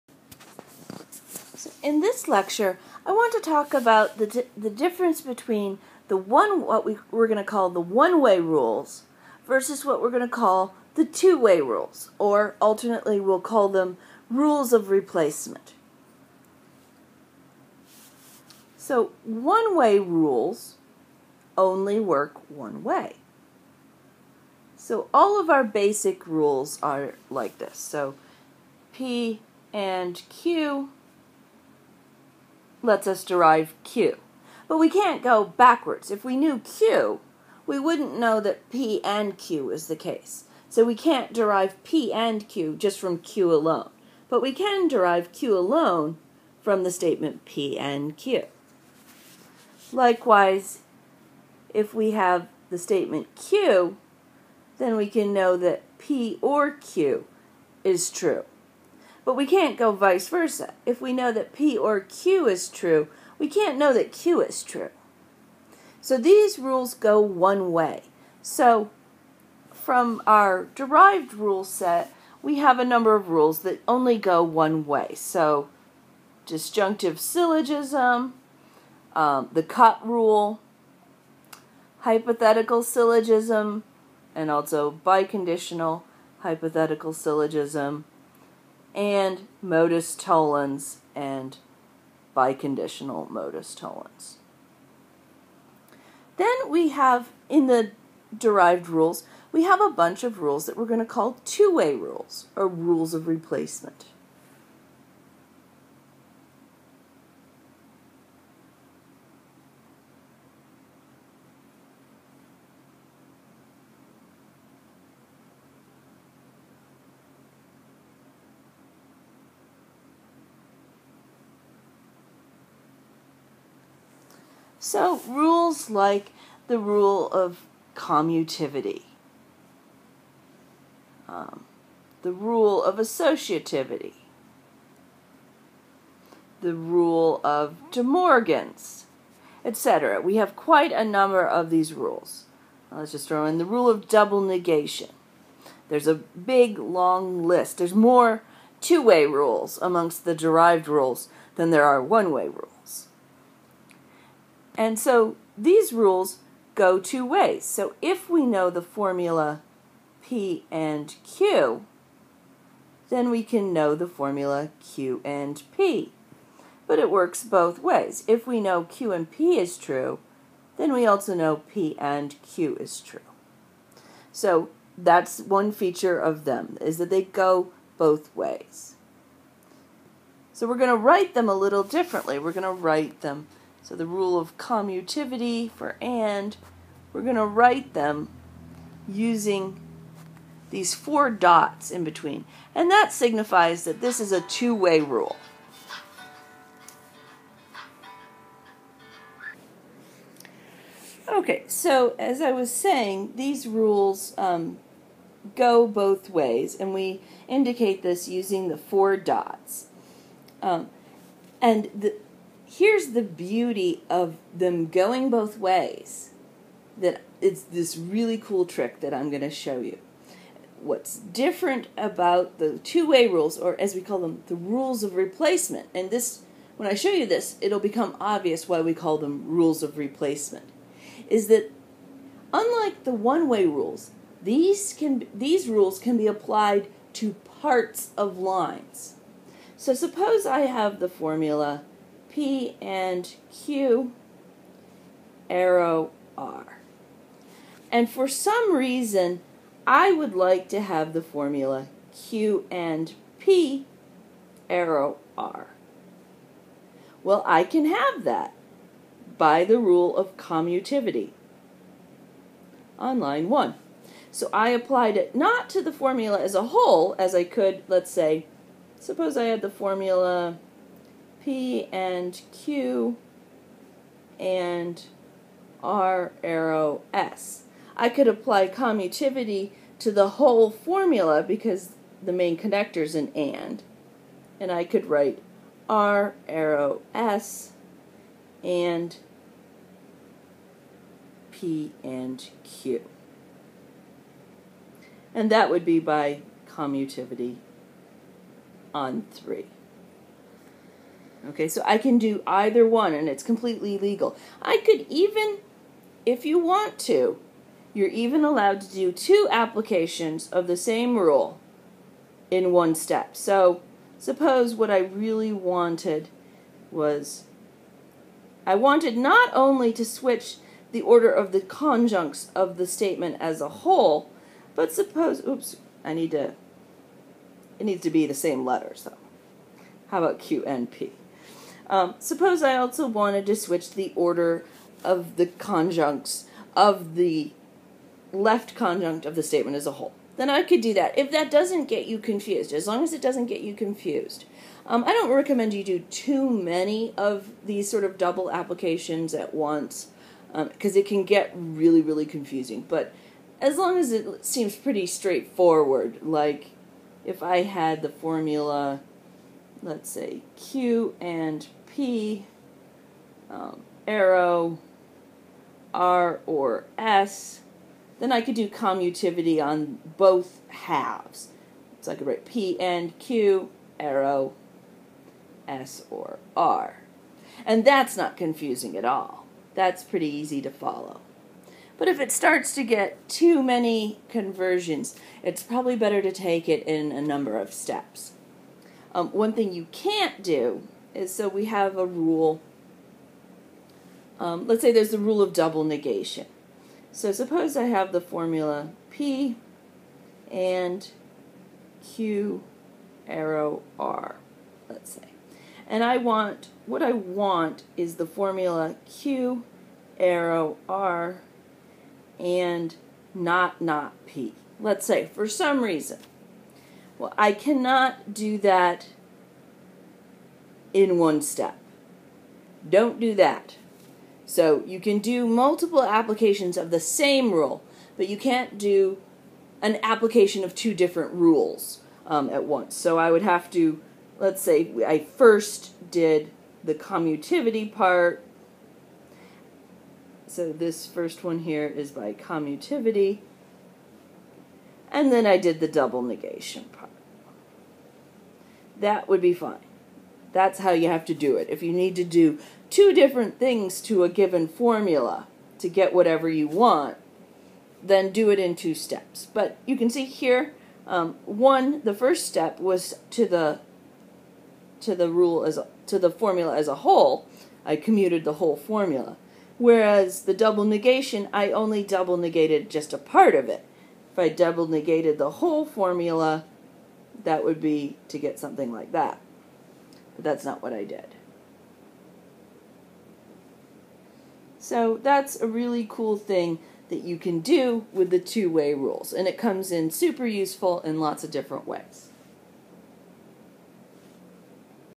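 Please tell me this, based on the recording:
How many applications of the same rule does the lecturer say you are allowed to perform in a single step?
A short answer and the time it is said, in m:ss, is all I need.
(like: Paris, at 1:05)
2, at 5:09.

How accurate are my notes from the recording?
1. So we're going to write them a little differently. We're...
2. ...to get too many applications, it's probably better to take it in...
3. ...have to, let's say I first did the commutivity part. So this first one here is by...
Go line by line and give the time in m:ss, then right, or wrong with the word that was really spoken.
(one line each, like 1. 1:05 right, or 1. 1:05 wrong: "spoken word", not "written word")
1. 3:00 right
2. 6:22 wrong: "conversions", not "applications"
3. 7:13 right.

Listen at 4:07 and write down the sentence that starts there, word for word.
And for some reason, I would like to have the formula Q and P, arrow R.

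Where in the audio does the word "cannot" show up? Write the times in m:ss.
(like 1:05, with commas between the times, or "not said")
6:57.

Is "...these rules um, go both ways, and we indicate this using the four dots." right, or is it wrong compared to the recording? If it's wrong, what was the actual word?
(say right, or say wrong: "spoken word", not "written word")
right.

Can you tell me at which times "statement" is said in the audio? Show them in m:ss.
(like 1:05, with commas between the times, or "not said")
0:46, 0:52, 5:22, 5:39.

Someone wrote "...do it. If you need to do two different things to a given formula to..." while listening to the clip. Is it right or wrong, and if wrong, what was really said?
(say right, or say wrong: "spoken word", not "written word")
right.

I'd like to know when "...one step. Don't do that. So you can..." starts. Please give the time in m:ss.
7:01.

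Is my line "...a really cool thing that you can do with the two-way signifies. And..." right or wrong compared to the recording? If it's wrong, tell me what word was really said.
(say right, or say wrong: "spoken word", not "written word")
wrong: "rules", not "signifies".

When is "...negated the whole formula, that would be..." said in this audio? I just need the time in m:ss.
7:54.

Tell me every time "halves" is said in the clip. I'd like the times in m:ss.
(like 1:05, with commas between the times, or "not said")
6:10.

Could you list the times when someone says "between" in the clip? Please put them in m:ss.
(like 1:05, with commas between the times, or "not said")
0:05, 3:12.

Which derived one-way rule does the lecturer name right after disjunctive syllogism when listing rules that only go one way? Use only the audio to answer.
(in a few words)
the cut rule.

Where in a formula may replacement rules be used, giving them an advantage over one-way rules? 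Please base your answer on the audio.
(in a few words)
applied to parts of lines.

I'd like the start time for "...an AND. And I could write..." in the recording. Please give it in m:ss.
4:43.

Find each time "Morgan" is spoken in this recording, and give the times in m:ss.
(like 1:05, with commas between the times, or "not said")
2:18.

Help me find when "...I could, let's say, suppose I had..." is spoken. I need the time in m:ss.
4:27.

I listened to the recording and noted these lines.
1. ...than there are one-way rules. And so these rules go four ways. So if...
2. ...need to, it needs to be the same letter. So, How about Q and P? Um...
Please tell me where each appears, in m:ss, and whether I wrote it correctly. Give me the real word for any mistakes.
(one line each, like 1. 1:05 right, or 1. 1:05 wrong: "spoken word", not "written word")
1. 2:31 wrong: "two", not "four"
2. 5:26 right.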